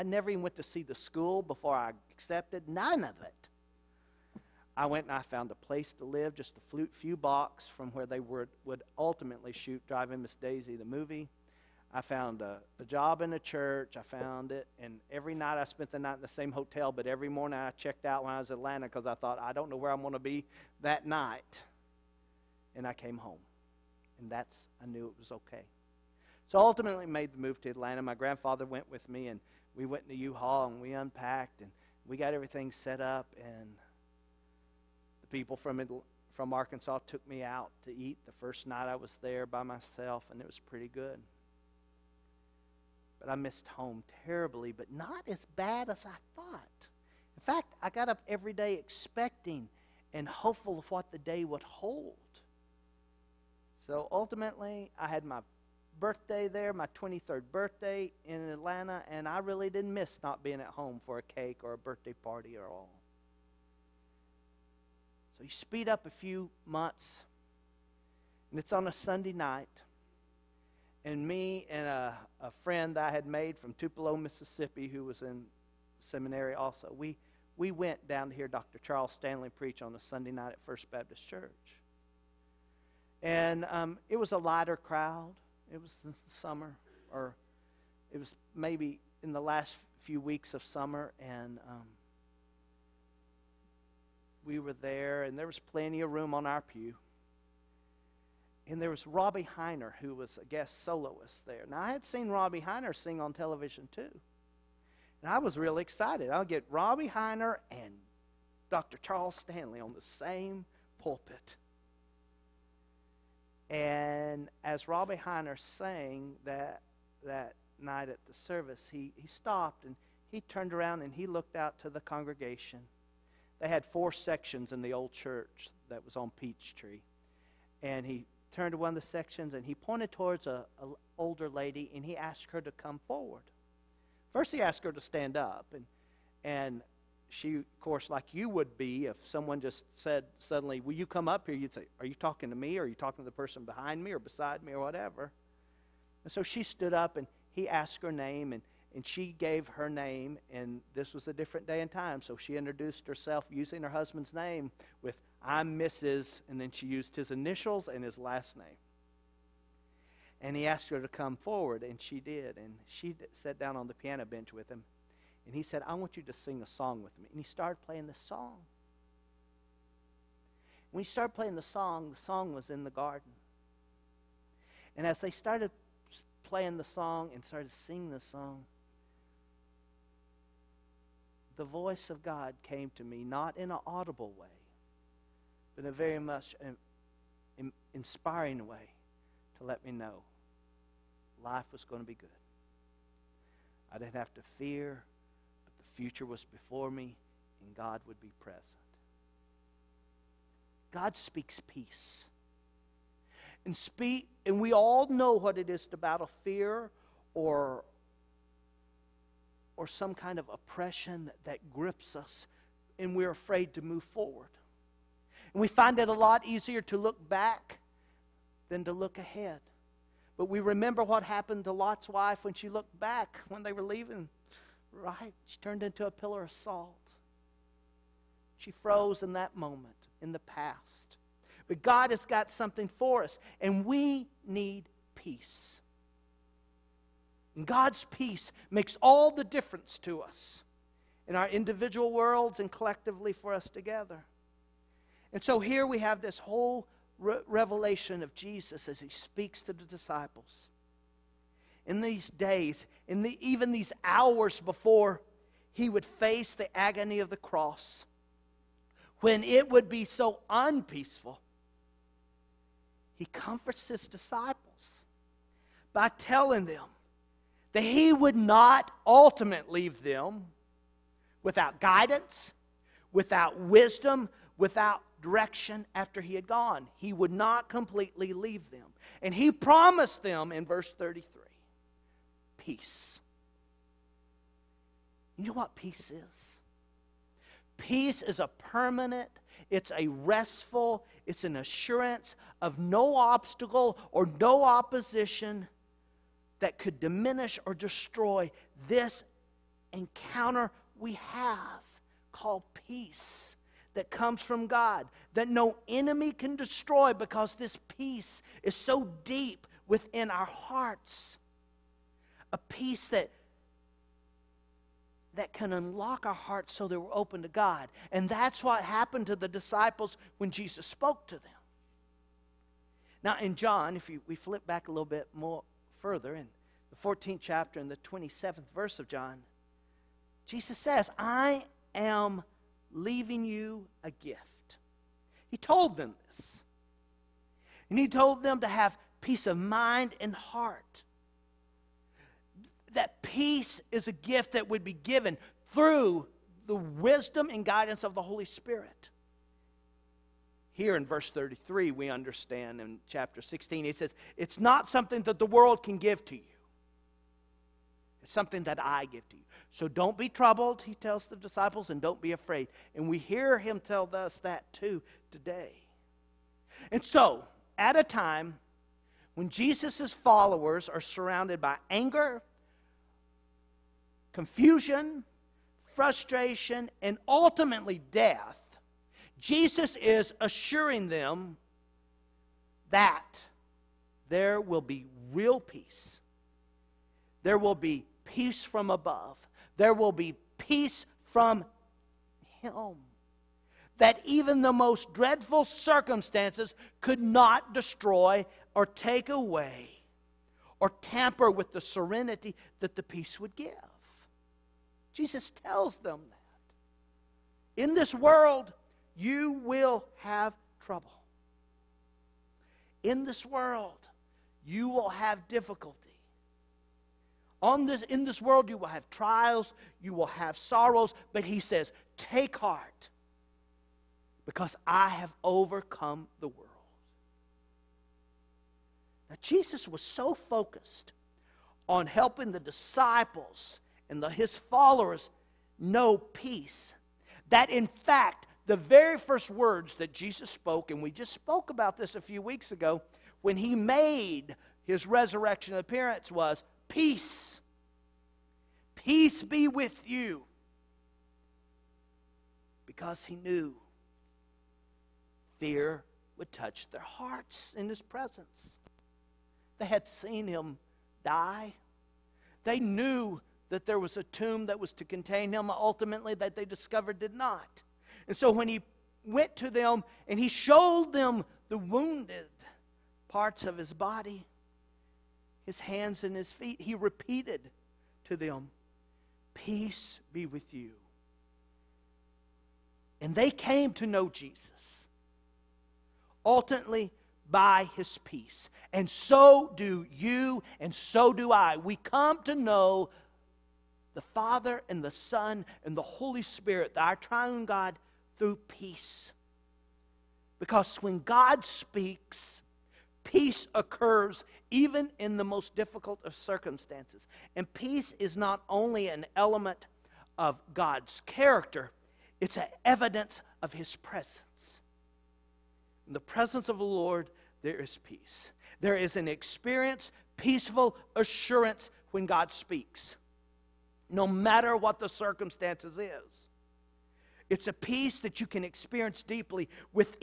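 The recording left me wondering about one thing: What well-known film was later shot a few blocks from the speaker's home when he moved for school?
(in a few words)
Driving Miss Daisy.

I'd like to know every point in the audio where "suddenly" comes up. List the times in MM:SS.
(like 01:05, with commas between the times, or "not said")
02:20.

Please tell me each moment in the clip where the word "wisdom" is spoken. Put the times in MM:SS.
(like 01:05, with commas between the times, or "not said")
04:33, 05:46.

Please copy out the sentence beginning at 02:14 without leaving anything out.
First, he asked her to stand up.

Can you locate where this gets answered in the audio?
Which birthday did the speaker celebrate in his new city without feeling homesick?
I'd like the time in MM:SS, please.
00:56.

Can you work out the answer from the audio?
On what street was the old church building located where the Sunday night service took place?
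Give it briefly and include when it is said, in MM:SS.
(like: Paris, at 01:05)
Peachtree, at 02:06.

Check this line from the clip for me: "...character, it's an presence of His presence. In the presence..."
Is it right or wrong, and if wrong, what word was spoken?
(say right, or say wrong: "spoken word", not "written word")
wrong: "evidence", not "presence".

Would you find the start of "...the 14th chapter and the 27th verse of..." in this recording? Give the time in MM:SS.
05:26.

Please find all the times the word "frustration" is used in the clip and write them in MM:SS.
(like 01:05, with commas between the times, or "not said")
06:15.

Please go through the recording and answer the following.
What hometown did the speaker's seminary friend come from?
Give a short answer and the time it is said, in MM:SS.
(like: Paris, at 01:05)
Tupelo, Mississippi, at 01:13.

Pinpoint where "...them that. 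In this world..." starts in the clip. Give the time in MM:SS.
06:45.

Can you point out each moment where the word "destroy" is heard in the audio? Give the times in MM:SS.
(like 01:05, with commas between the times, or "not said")
04:57, 05:06, 06:37.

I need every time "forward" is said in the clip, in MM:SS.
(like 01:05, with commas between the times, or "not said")
02:13, 02:41, 03:34.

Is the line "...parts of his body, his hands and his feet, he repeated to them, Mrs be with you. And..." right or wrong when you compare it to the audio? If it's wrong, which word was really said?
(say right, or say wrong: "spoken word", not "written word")
wrong: "Peace", not "Mrs".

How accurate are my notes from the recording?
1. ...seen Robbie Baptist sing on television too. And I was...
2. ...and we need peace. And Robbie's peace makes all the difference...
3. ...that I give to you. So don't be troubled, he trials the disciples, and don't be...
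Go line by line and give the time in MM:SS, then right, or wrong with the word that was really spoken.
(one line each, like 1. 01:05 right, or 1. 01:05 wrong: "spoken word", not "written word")
1. 01:42 wrong: "Hiner", not "Baptist"
2. 03:53 wrong: "God", not "Robbie"
3. 05:58 wrong: "tells", not "trials".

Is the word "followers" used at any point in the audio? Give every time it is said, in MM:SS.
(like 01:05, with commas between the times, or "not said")
06:10, 07:14.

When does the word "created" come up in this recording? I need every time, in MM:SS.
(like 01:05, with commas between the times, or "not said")
not said.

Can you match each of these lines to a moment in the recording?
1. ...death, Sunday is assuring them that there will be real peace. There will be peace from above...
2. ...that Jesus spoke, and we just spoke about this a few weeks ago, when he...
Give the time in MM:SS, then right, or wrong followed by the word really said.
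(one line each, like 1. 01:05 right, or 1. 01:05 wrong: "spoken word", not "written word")
1. 06:18 wrong: "Jesus", not "Sunday"
2. 07:19 right.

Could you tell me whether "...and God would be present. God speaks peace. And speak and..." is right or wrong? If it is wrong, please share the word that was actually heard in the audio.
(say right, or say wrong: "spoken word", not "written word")
right.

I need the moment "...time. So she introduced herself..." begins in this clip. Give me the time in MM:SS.
02:31.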